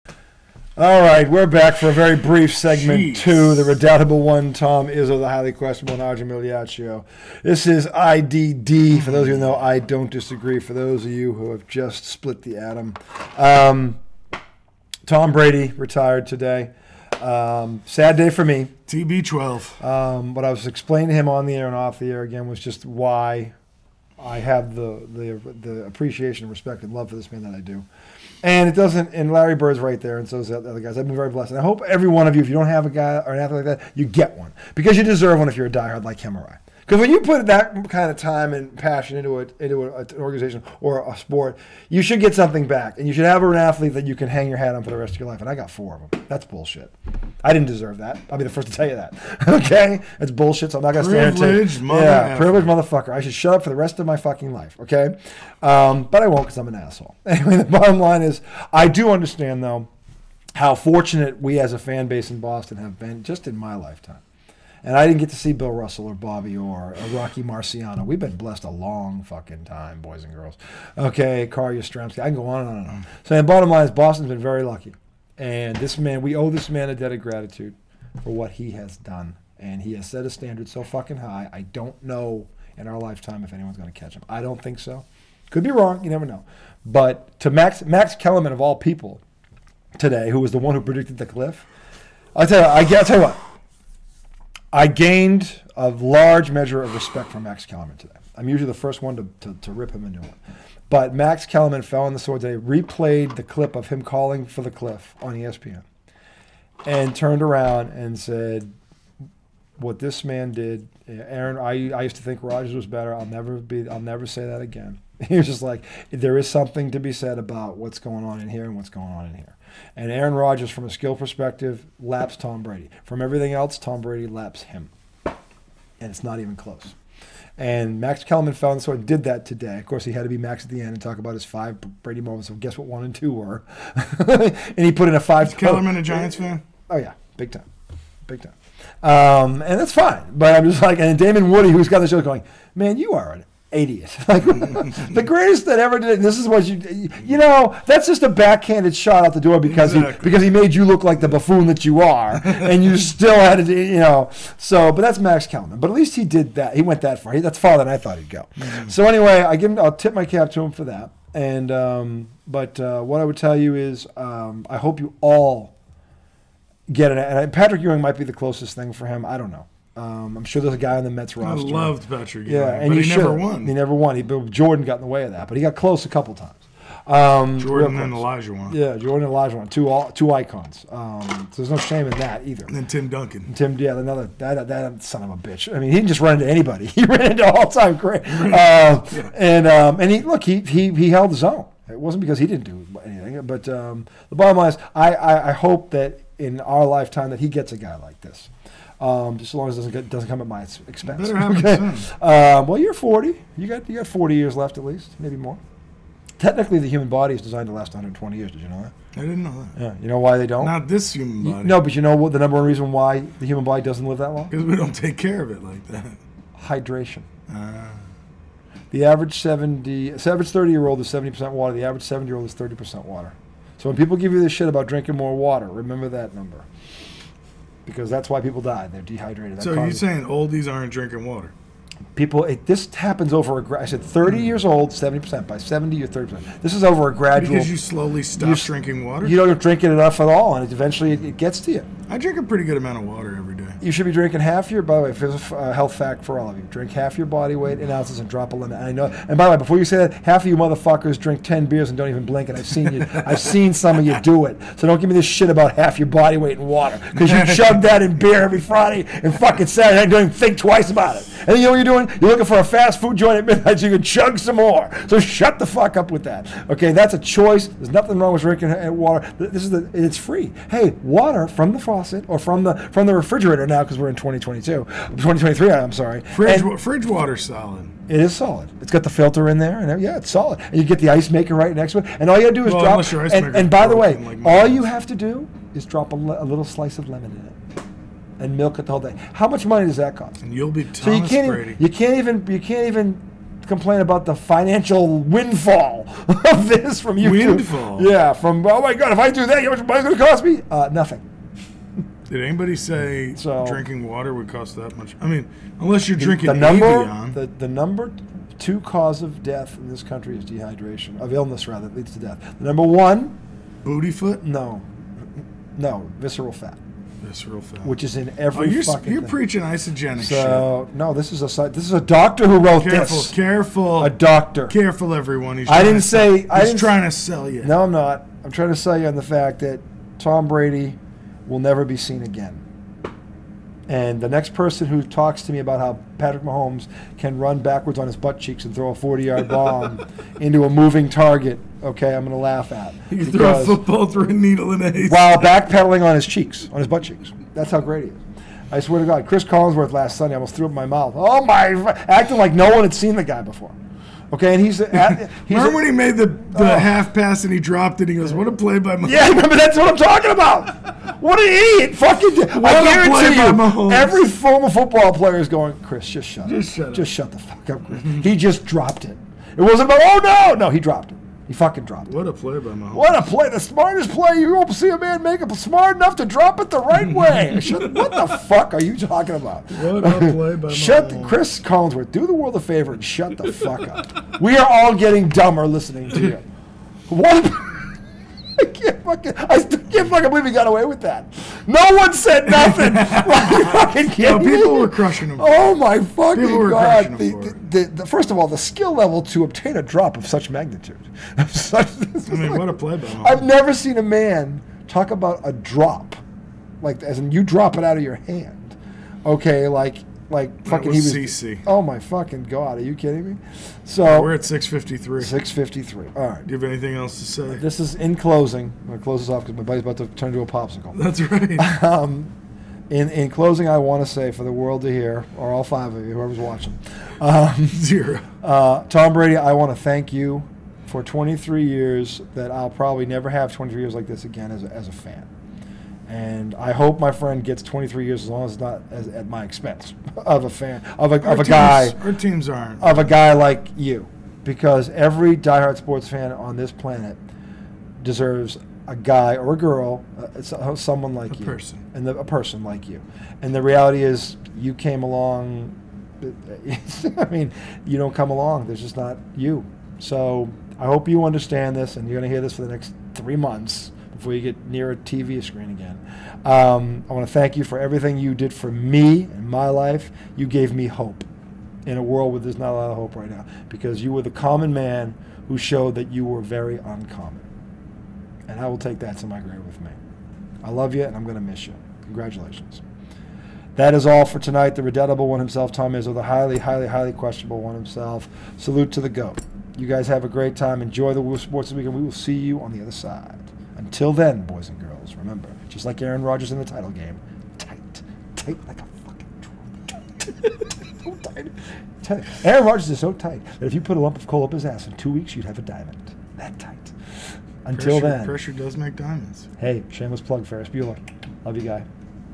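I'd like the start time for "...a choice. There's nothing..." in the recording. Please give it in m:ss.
4:27.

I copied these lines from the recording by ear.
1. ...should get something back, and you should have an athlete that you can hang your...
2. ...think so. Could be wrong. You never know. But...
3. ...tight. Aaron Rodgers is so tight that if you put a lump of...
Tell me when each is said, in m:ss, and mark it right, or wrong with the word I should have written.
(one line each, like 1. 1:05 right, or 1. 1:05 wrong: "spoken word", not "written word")
1. 0:42 right
2. 1:24 right
3. 8:22 right.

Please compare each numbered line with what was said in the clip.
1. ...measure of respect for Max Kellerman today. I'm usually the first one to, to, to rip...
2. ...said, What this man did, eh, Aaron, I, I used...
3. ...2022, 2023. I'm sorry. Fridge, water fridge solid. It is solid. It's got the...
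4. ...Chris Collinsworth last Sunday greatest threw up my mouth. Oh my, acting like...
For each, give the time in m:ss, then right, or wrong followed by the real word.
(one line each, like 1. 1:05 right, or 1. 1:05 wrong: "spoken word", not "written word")
1. 1:36 right
2. 1:48 right
3. 4:34 right
4. 5:49 wrong: "almost", not "greatest".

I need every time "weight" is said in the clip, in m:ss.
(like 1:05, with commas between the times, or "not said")
4:07, 4:16.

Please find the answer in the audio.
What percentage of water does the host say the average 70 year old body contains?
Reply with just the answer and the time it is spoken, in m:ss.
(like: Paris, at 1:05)
30%, at 3:42.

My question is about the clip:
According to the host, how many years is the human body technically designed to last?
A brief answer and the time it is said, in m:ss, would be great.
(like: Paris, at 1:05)
120, at 3:27.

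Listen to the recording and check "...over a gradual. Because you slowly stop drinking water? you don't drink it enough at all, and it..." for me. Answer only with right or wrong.
right.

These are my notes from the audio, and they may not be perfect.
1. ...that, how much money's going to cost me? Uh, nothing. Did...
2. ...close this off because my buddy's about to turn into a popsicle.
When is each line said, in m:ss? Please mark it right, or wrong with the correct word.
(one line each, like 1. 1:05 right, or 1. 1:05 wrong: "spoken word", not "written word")
1. 4:59 right
2. 6:58 right.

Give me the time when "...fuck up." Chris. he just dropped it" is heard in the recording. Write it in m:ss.
6:07.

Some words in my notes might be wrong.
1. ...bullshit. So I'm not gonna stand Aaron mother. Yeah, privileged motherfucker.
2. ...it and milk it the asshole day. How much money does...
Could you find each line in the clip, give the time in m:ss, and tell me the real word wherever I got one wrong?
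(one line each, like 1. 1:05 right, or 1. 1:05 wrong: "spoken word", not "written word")
1. 0:50 wrong: "Privileged", not "Aaron"
2. 4:47 wrong: "whole", not "asshole".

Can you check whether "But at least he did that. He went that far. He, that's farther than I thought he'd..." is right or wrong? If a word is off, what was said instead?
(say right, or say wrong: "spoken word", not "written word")
right.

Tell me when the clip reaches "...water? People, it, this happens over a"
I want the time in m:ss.
3:51.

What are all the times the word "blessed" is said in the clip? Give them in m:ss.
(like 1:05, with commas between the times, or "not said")
0:31, 1:08.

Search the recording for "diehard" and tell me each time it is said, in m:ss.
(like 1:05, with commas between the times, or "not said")
0:35, 7:25.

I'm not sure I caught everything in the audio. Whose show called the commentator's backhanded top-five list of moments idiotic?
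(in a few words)
Damon Woody.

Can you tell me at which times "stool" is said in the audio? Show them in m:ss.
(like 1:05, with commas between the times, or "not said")
not said.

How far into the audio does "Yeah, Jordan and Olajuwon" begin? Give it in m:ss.
2:58.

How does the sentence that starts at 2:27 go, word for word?
That's just a backhanded shot out the door because exactly.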